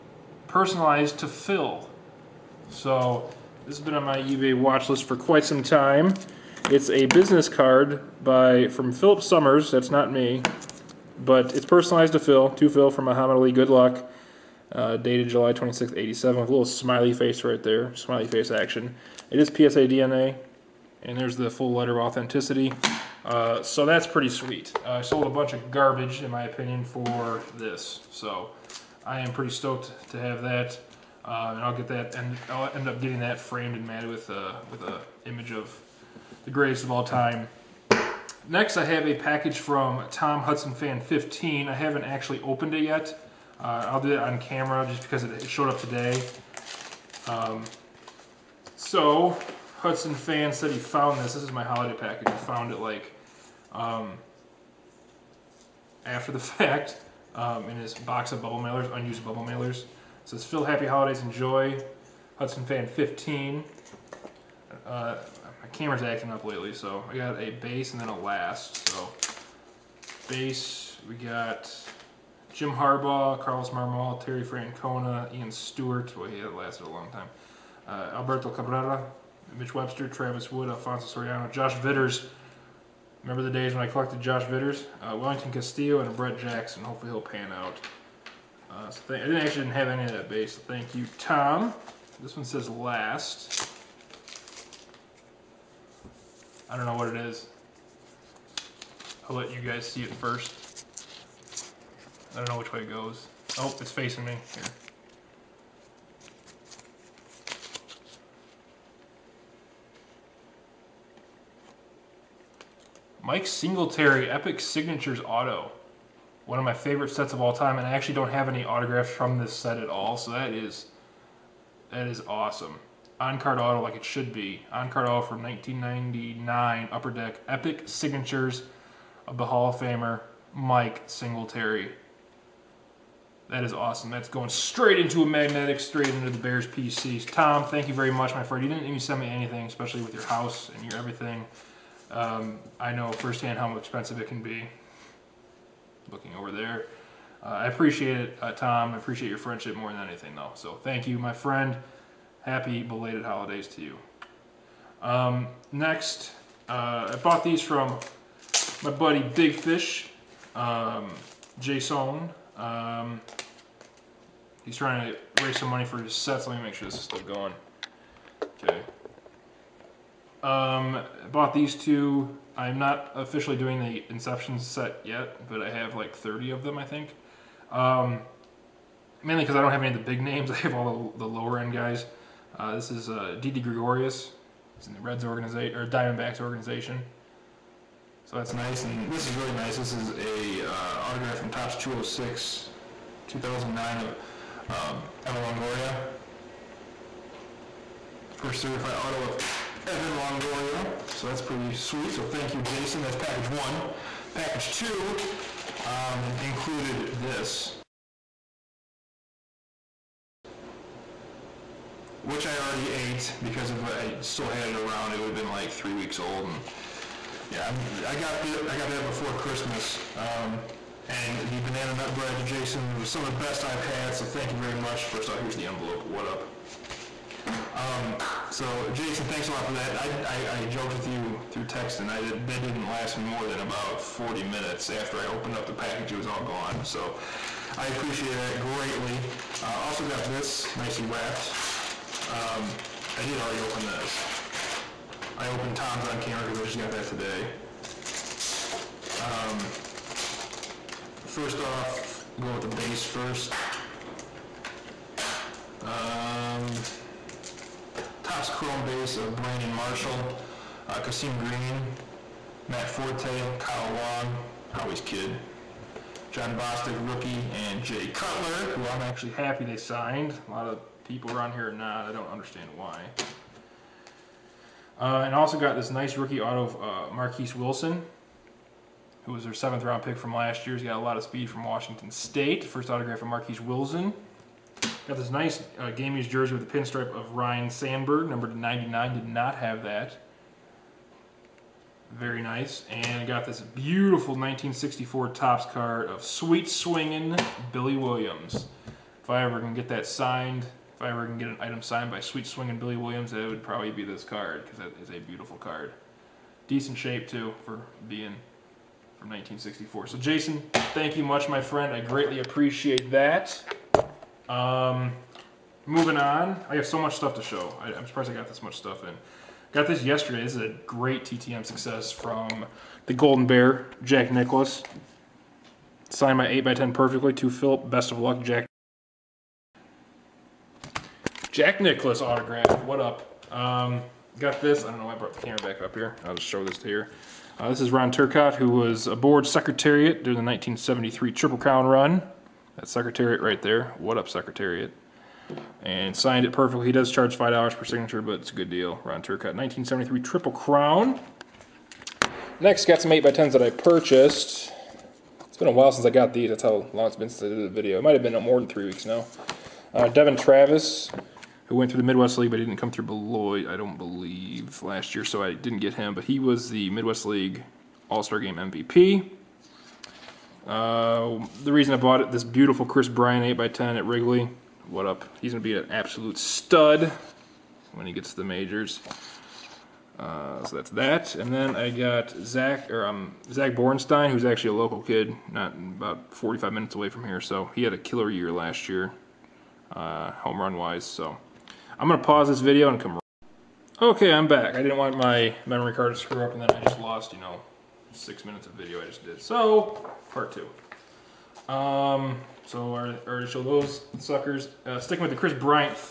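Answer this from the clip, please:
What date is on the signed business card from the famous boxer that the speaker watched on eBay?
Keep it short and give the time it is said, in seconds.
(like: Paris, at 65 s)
July 26, 87, at 15 s.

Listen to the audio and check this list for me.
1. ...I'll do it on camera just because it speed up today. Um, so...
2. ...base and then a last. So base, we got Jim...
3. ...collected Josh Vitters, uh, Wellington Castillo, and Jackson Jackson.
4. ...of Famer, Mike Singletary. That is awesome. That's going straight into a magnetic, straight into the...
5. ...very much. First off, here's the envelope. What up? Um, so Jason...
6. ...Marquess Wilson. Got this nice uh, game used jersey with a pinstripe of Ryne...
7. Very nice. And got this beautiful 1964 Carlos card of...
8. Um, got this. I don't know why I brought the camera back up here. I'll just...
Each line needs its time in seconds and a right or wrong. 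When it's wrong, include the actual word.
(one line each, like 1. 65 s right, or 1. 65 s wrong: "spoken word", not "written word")
1. 43 s wrong: "showed", not "speed"
2. 67 s right
3. 83 s wrong: "Brett", not "Jackson"
4. 129 s right
5. 224 s right
6. 283 s right
7. 292 s wrong: "Topps", not "Carlos"
8. 333 s right.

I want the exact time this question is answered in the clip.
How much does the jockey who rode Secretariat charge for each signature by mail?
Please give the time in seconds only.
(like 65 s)
347 s.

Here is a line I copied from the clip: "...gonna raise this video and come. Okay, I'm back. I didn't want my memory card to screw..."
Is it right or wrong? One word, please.
wrong.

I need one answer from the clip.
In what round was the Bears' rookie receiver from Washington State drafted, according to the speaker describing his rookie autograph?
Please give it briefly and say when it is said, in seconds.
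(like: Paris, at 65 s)
seventh round, at 279 s.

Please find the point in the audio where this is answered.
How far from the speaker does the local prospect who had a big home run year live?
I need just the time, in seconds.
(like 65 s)
386 s.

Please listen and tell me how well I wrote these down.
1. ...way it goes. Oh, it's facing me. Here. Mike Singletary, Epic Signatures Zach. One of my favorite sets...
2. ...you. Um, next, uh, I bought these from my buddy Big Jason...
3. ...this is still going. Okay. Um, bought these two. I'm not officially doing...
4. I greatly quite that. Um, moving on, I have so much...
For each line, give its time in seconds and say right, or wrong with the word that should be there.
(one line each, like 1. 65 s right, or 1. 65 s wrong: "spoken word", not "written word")
1. 102 s wrong: "Auto", not "Zach"
2. 153 s wrong: "Fish", not "Jason"
3. 166 s right
4. 311 s wrong: "appreciate", not "quite".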